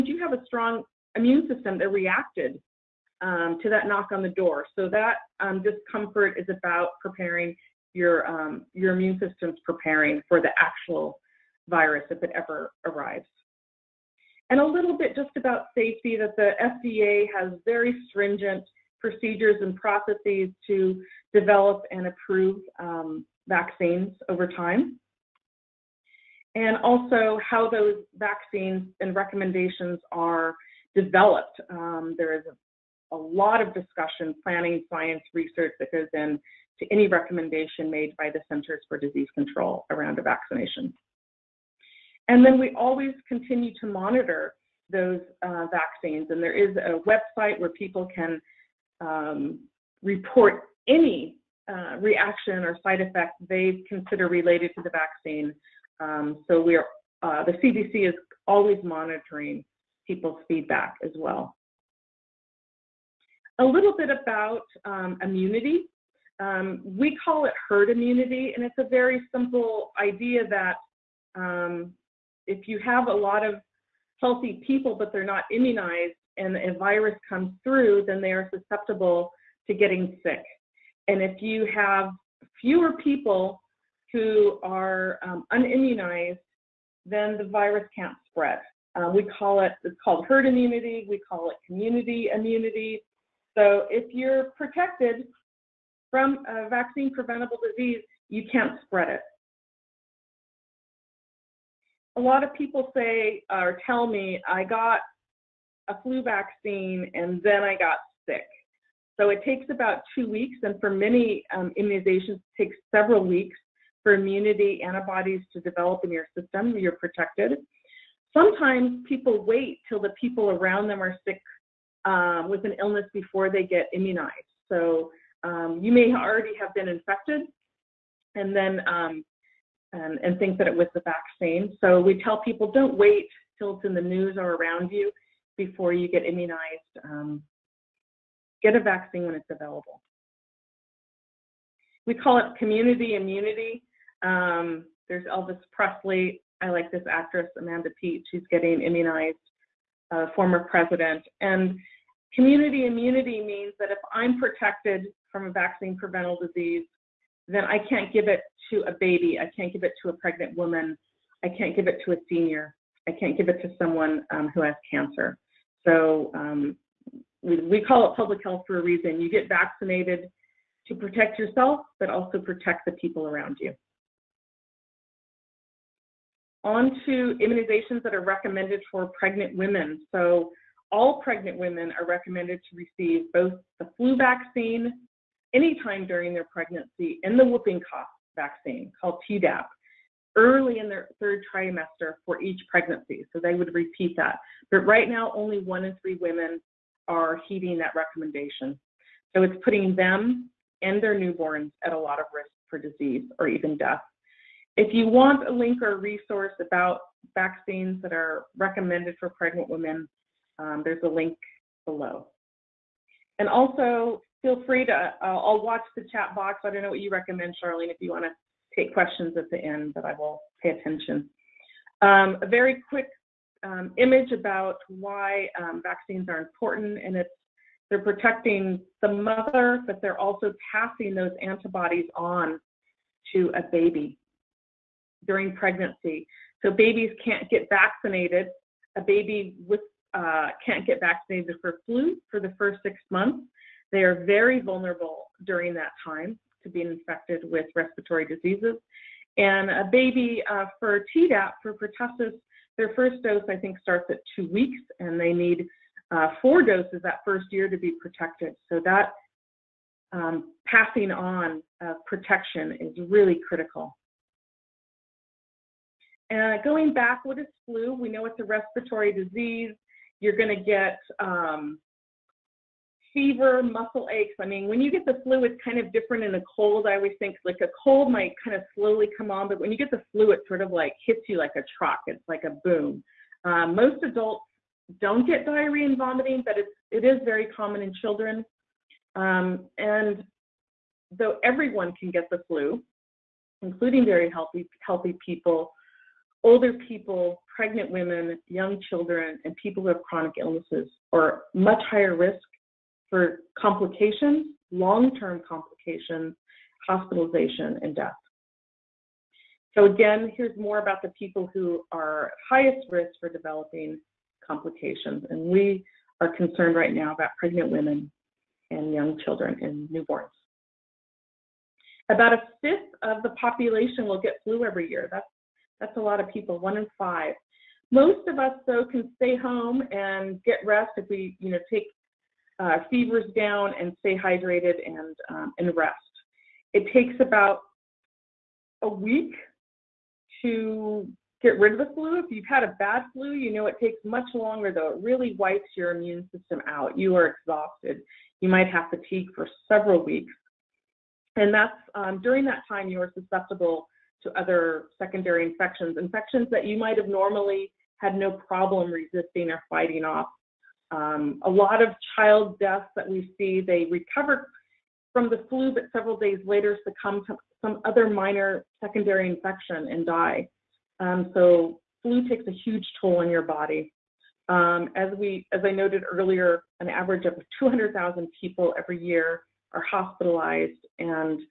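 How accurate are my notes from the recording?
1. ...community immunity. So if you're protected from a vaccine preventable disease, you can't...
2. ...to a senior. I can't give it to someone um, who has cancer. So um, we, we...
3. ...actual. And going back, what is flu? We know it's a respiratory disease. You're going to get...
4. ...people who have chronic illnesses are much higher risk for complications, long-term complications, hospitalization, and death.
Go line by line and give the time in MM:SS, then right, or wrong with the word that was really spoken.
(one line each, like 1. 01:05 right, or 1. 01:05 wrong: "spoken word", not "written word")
1. 01:31 right
2. 02:42 right
3. 04:23 wrong: "critical", not "actual"
4. 04:59 right.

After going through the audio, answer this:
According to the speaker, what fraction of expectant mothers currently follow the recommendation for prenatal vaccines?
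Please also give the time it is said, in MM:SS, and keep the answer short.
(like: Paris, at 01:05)
one in three, at 03:15.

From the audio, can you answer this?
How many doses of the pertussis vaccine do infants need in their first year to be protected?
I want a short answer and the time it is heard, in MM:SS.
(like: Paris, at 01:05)
4, at 04:16.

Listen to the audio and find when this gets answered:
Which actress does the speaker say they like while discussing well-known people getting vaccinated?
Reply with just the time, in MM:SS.
02:27.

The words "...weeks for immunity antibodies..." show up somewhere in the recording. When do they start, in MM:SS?
01:53.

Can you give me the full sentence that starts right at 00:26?
And also how those vaccines and recommendations are developed.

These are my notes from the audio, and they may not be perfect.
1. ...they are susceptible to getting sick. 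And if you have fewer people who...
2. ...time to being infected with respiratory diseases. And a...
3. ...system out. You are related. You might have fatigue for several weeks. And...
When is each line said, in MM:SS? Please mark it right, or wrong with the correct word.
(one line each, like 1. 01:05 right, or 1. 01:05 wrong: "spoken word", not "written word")
1. 01:18 right
2. 04:06 right
3. 05:46 wrong: "exhausted", not "related".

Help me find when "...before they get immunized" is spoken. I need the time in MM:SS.
02:03.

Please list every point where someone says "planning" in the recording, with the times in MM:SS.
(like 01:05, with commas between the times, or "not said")
00:34.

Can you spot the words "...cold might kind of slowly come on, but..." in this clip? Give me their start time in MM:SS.
04:37.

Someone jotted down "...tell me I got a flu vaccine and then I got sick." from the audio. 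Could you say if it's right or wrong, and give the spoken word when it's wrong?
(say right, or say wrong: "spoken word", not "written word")
right.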